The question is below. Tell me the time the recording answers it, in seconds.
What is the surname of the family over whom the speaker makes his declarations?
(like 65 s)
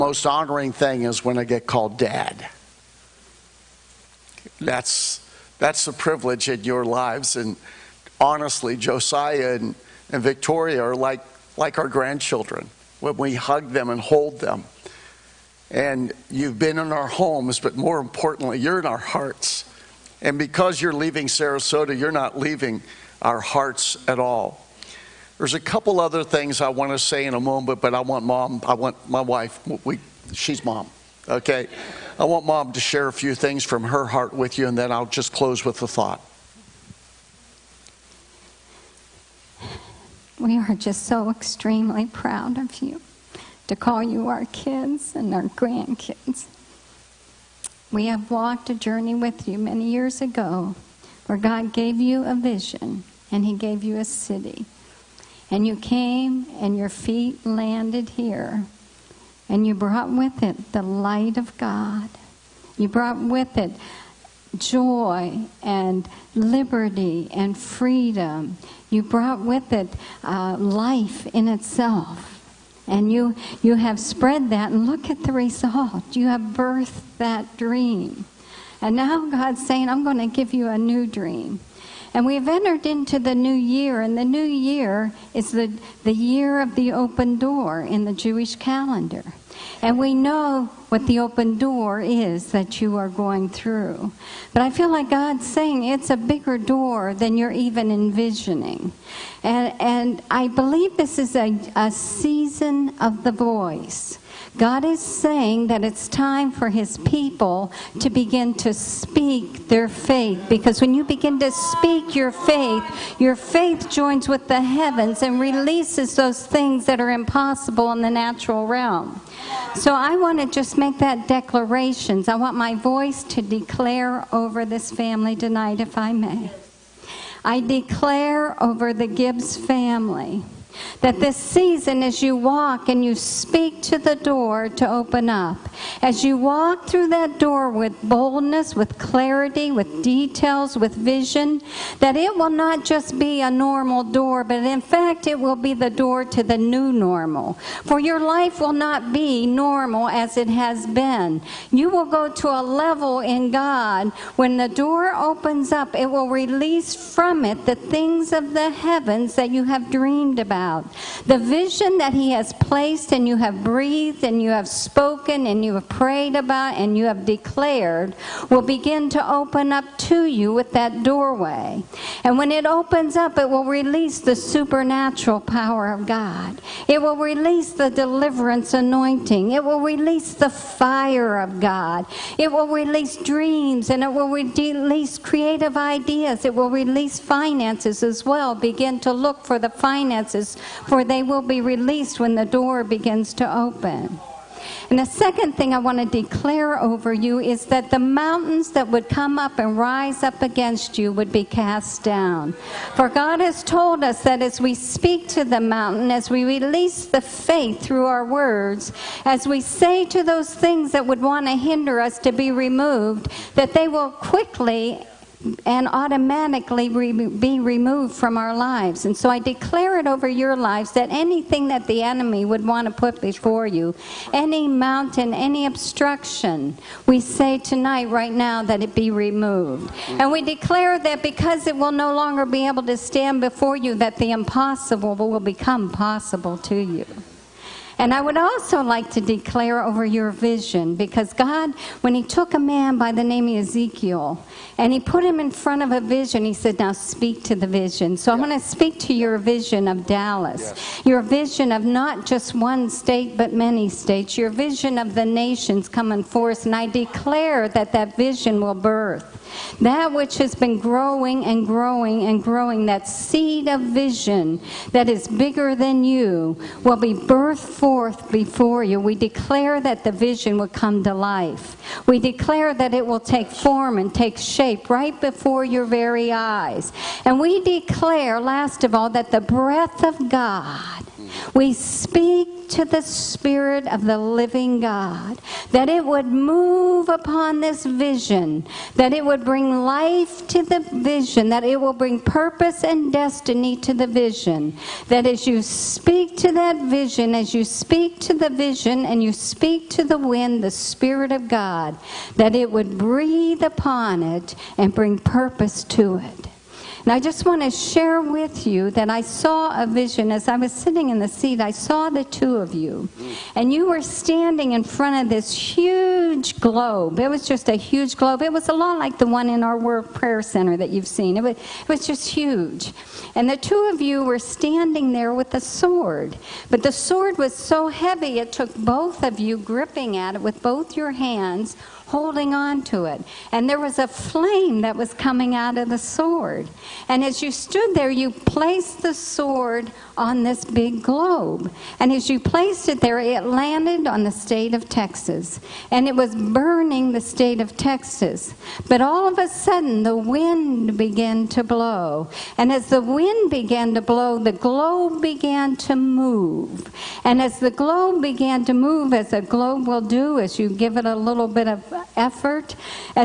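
129 s.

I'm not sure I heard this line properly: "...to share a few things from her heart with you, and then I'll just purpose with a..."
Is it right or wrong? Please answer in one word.
wrong.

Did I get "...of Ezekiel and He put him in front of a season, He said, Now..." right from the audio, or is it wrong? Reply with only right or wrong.
wrong.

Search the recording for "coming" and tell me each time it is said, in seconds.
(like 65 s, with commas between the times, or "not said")
255 s, 335 s.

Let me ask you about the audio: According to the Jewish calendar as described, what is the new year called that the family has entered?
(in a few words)
the year of the open door.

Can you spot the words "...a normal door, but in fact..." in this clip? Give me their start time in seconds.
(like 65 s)
143 s.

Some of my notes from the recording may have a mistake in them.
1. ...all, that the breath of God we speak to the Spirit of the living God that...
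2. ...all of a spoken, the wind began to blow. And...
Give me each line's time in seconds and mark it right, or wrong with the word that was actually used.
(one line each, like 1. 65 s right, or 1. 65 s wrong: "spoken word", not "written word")
1. 278 s right
2. 349 s wrong: "sudden", not "spoken".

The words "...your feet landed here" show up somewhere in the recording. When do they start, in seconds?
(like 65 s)
56 s.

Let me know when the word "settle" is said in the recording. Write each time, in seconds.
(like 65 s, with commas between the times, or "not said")
not said.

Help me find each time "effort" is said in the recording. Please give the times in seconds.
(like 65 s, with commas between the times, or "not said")
362 s.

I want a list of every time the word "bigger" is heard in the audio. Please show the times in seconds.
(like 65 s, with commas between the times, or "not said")
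96 s, 265 s.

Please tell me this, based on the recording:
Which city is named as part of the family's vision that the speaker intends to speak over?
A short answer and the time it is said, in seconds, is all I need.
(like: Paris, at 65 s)
Dallas, at 250 s.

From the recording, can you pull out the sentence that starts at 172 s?
And when it opens up, it will release the supernatural power of God.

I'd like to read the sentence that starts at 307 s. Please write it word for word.
And I just want to share with you that I saw a vision as I was sitting in the seat.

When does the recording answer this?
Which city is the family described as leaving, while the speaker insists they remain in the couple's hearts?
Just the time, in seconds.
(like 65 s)
21 s.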